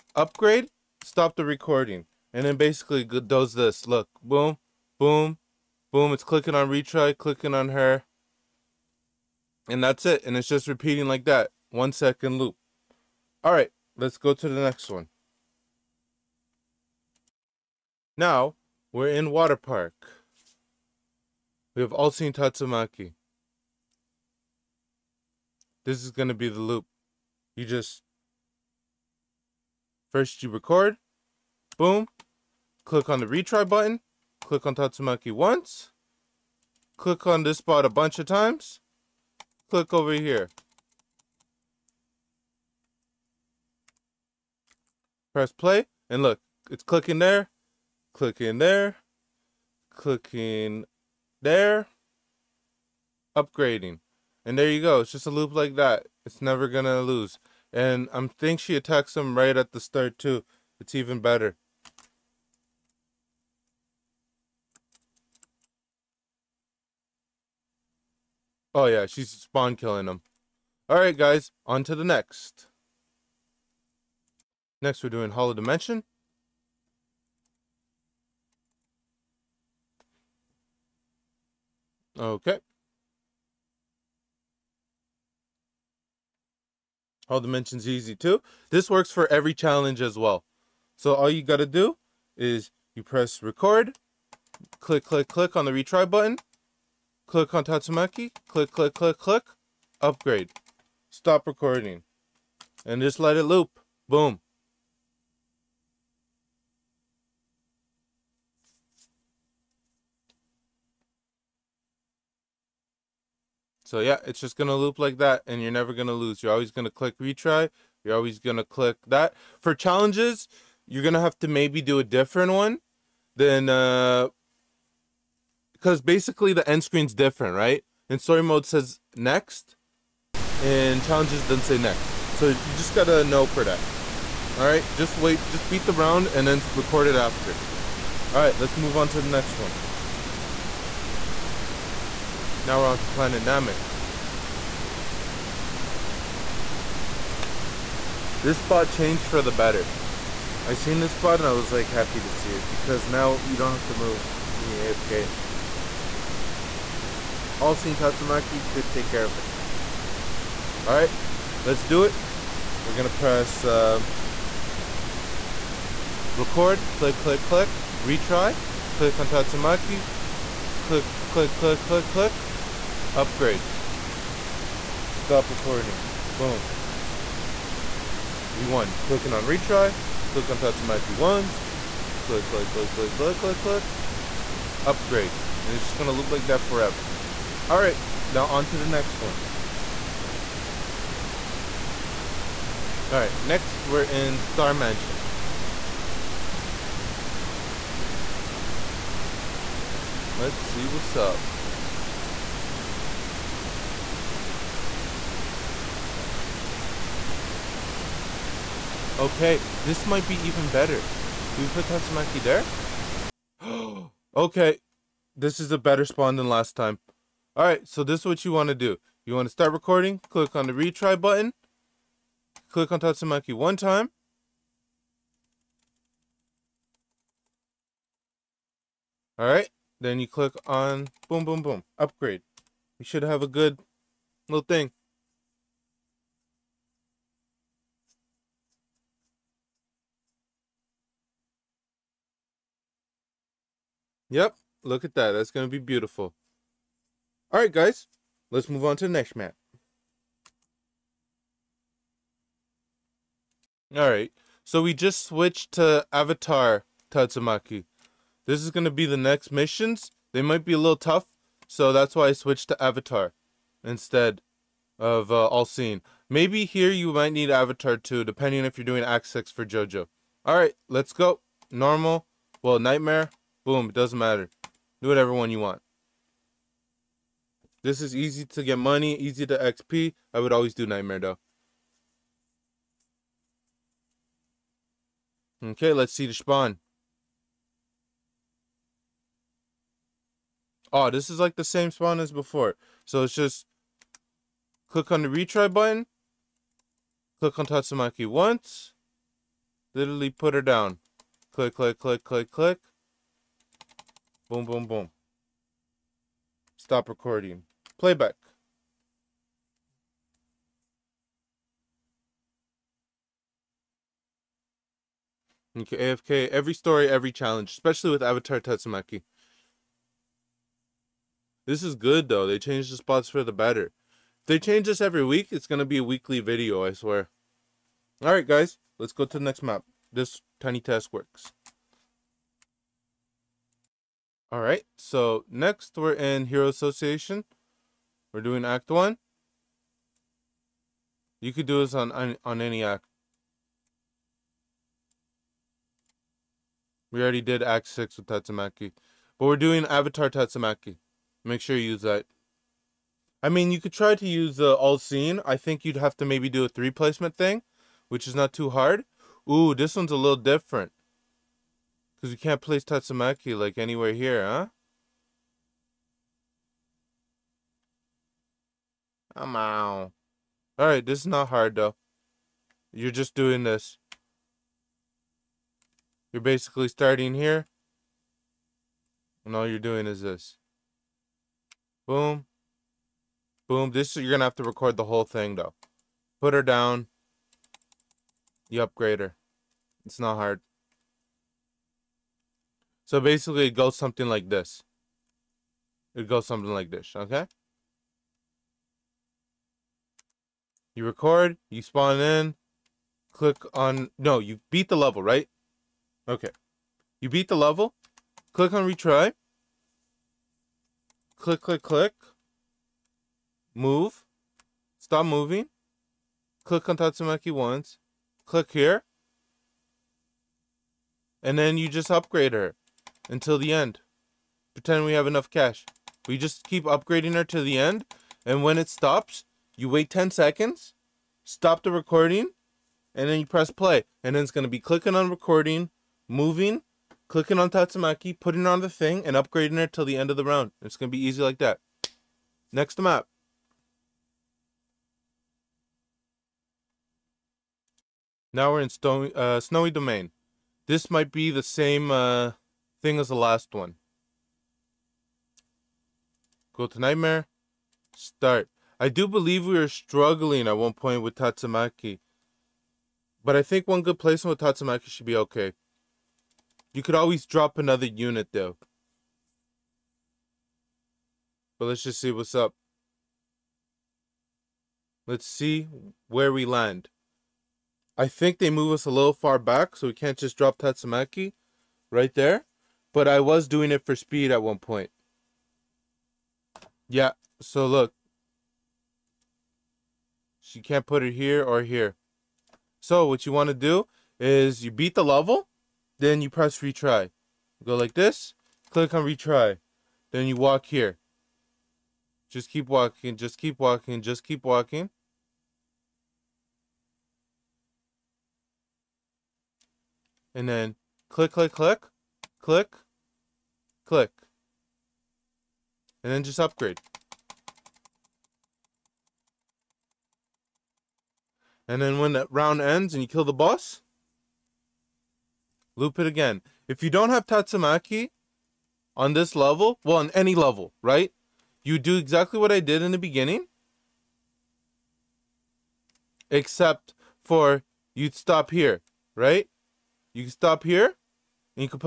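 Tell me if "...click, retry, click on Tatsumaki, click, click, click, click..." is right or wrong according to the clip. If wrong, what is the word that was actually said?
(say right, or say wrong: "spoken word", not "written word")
right.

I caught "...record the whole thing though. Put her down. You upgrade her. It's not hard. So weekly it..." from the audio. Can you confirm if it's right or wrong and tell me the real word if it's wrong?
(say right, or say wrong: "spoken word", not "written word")
wrong: "basically", not "weekly".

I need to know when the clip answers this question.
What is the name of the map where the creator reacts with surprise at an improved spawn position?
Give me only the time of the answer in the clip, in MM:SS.
03:14.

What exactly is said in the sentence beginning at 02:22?
Now we're on to planet Namek.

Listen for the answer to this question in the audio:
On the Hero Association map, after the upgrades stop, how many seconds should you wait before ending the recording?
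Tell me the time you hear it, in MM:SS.
07:10.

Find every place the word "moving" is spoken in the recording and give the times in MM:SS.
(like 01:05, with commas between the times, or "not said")
06:55, 07:16.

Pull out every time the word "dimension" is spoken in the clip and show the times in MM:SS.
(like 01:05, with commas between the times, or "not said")
01:15, 01:27.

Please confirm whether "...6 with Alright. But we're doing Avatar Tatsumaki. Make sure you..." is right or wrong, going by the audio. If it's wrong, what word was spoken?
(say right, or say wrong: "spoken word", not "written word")
wrong: "Tatsumaki", not "Alright".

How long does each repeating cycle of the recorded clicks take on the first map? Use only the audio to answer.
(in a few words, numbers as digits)
1 second.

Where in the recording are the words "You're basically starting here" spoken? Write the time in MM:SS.
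06:16.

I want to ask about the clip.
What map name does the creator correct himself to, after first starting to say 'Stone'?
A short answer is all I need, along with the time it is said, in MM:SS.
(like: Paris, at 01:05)
Snowy Domain, at 07:29.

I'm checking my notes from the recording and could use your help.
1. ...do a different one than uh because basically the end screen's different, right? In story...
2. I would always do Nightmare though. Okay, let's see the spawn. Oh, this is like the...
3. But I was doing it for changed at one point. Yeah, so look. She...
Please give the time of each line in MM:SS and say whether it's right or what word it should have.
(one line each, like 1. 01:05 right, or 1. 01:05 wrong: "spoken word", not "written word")
1. 02:01 right
2. 04:40 right
3. 08:03 wrong: "speed", not "changed".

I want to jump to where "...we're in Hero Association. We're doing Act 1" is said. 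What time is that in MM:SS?
05:35.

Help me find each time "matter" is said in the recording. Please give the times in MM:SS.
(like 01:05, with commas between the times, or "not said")
04:34.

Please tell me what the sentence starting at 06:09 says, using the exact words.
I'm Alright, this is not hard though.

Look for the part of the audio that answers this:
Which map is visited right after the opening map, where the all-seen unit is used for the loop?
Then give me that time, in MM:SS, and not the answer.
00:19.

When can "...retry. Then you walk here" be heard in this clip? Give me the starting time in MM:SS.
08:19.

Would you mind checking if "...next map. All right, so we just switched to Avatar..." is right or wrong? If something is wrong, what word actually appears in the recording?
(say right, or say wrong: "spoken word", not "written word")
right.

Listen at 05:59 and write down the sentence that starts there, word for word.
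Ooh, this one's a little different.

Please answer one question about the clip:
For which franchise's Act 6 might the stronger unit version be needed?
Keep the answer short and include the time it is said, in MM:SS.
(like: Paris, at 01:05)
JoJo, at 04:29.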